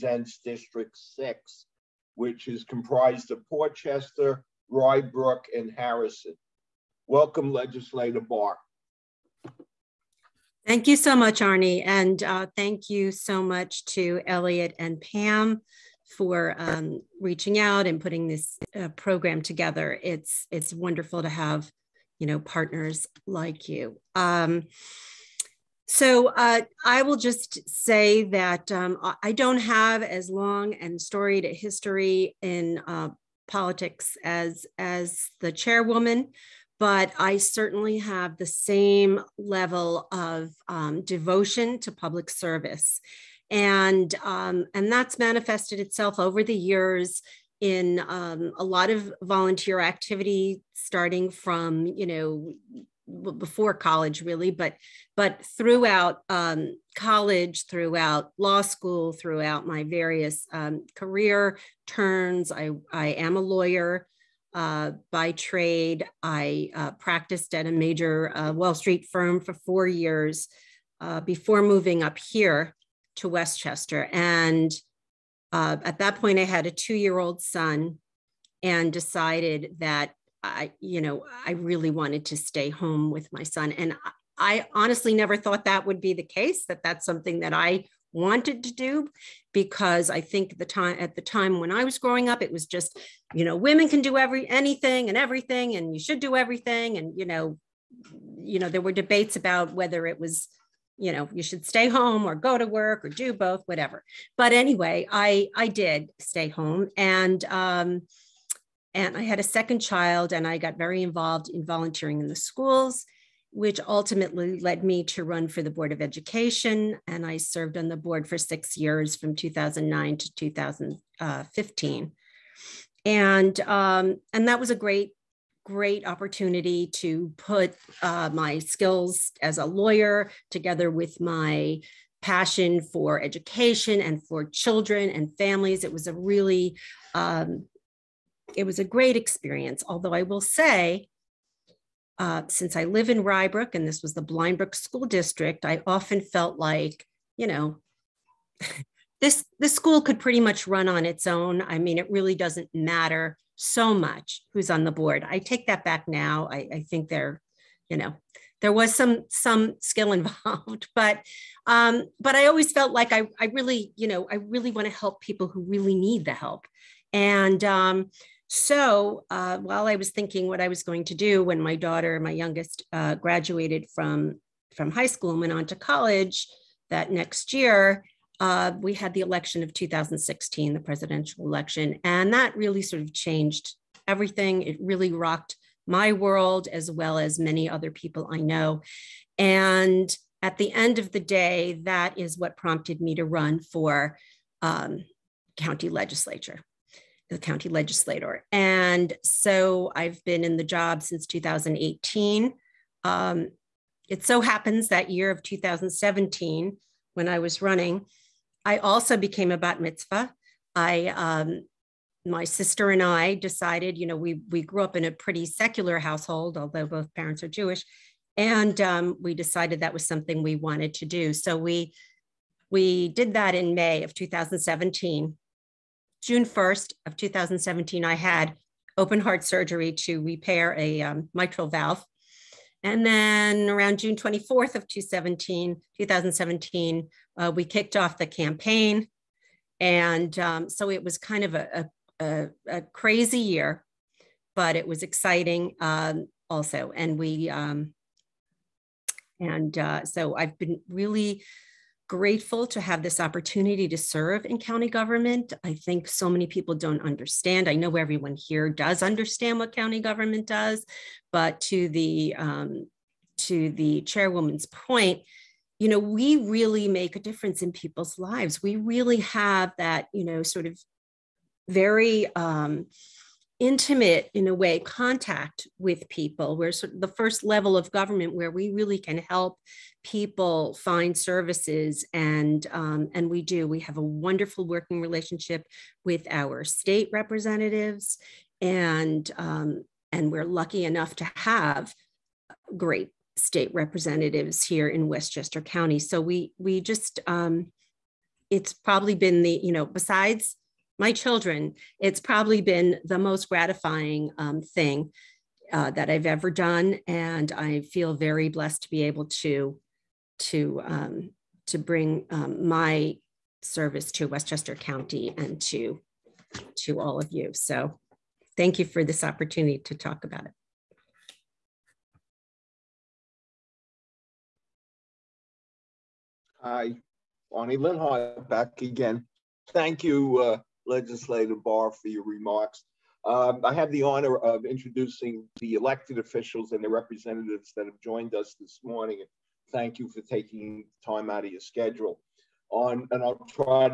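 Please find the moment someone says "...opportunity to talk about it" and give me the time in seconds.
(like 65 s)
319 s.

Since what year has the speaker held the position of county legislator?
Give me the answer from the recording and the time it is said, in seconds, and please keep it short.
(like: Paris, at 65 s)
2018, at 201 s.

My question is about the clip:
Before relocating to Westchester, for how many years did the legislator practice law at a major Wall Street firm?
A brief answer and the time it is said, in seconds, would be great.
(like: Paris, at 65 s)
4, at 69 s.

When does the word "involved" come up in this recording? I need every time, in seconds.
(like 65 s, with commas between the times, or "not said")
111 s, 160 s.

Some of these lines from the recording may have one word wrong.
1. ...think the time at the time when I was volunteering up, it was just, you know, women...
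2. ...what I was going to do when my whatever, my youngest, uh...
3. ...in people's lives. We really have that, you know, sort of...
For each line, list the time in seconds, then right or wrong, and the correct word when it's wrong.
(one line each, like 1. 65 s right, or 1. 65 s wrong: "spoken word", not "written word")
1. 90 s wrong: "growing", not "volunteering"
2. 170 s wrong: "daughter", not "whatever"
3. 267 s right.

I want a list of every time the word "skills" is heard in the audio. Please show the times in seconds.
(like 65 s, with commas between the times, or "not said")
128 s, 159 s.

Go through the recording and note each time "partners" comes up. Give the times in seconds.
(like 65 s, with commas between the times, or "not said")
22 s.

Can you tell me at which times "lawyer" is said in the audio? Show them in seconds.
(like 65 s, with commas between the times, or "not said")
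63 s, 129 s.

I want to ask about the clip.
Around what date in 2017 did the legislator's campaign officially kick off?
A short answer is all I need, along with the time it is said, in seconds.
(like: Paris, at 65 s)
June 24th, at 233 s.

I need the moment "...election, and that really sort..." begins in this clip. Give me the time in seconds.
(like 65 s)
181 s.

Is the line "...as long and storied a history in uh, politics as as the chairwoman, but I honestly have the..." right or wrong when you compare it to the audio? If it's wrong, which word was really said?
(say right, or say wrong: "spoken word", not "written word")
wrong: "certainly", not "honestly".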